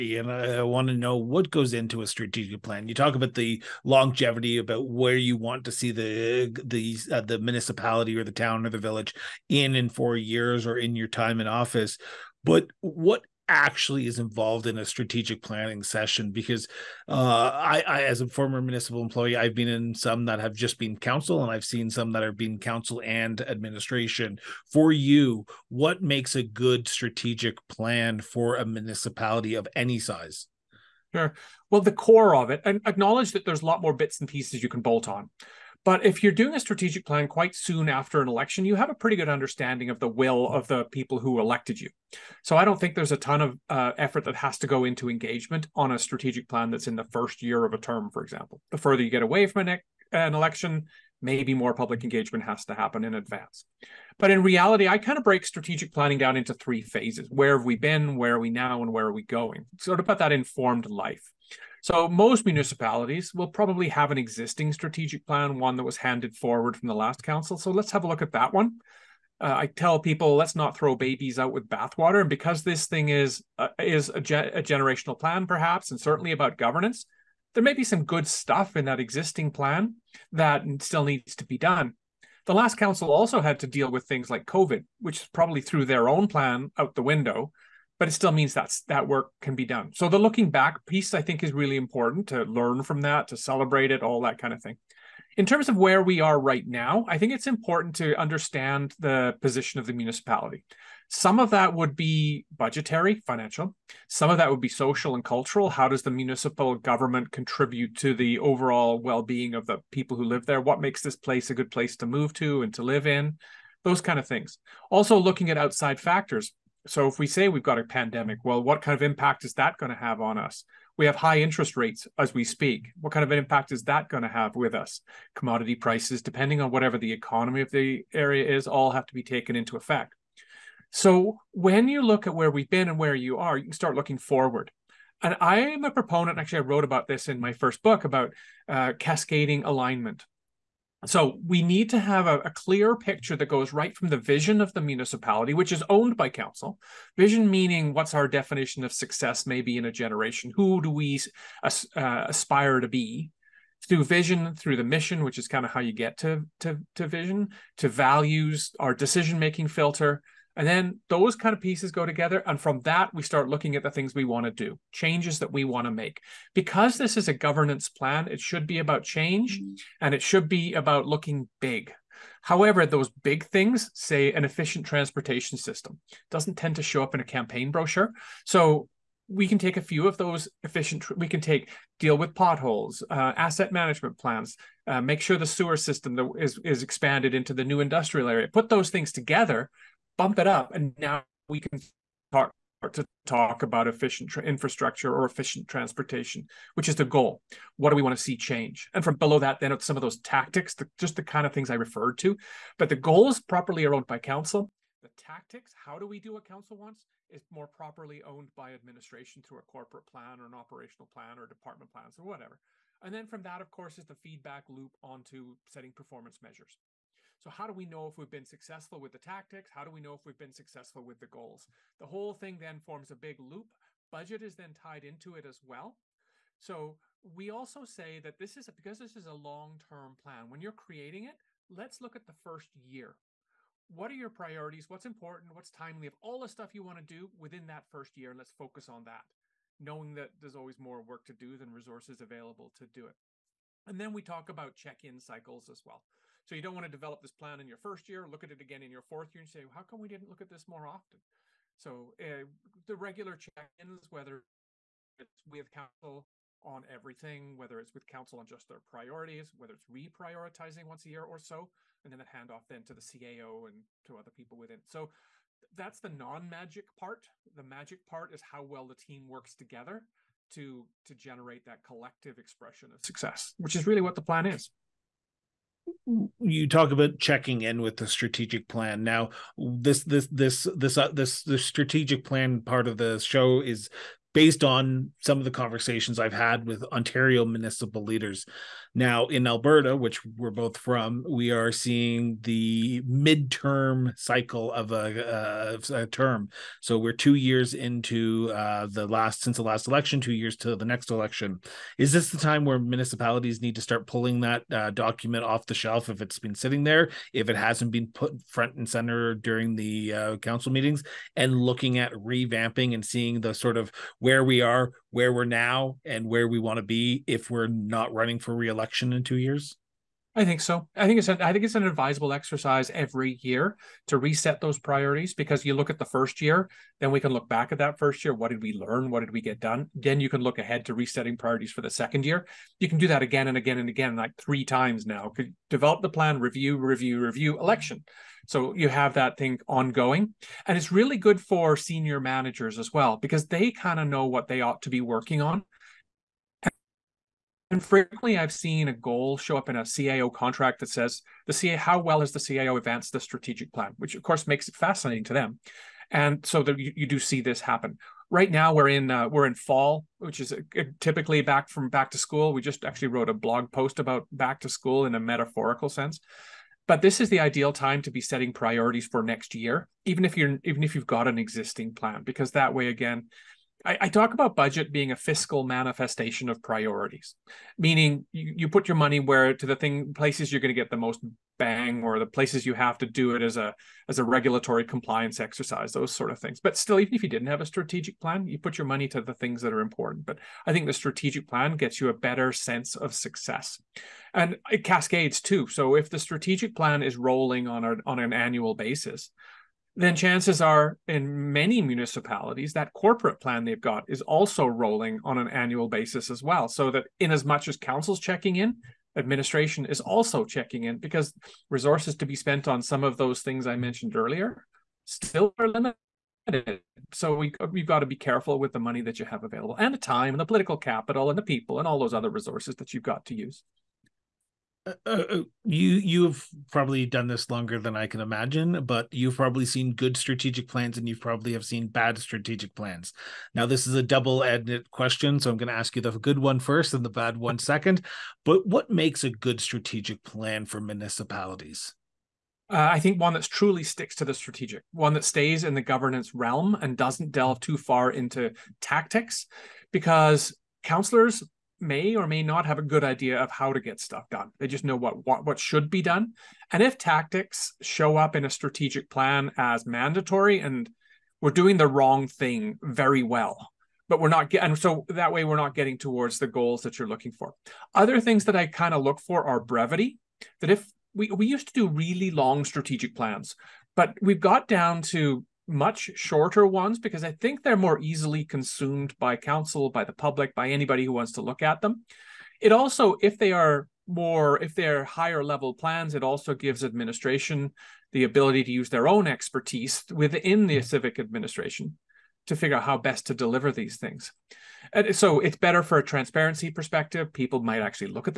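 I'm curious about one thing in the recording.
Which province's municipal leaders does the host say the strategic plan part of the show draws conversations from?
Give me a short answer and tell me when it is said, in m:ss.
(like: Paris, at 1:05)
Ontario, at 4:46.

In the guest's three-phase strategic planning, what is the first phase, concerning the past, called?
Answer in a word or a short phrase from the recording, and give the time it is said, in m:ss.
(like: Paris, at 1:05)
Where have we been, at 0:57.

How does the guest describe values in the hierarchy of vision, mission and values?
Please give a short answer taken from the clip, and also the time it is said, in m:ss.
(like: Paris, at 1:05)
Our decision making filter, at 2:38.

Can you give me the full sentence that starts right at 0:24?
For you, what makes a good strategic plan for a municipality of any size?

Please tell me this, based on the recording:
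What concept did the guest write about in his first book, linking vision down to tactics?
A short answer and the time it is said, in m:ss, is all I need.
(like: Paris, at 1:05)
Cascading alignment, at 2:18.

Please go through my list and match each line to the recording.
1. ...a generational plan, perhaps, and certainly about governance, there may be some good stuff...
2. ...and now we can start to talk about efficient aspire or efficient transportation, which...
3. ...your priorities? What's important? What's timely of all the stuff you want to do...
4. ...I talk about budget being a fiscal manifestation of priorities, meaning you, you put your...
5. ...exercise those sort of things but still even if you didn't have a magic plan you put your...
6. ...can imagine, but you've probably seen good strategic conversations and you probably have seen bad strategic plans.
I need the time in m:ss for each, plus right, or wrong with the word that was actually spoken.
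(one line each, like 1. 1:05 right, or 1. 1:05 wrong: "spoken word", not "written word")
1. 1:14 right
2. 3:10 wrong: "infrastructure", not "aspire"
3. 3:54 right
4. 6:13 right
5. 6:25 wrong: "strategic", not "magic"
6. 7:08 wrong: "plans", not "conversations".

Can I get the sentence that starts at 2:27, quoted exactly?
Vision meaning what's our definition of success, maybe in a generation?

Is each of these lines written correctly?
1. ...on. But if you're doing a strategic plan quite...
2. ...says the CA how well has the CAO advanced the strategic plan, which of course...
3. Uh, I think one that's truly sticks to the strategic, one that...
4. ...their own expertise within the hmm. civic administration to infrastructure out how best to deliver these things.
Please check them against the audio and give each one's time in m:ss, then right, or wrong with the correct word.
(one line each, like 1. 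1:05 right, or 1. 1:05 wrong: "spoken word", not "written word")
1. 0:35 right
2. 5:50 right
3. 7:22 right
4. 8:08 wrong: "figure", not "infrastructure".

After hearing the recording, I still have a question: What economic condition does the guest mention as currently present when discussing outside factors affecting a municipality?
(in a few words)
High interest rates.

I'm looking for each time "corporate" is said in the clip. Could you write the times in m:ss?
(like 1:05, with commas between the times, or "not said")
3:29, 6:42.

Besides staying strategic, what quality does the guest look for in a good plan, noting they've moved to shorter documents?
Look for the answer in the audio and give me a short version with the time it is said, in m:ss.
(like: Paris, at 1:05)
Brevity, at 7:49.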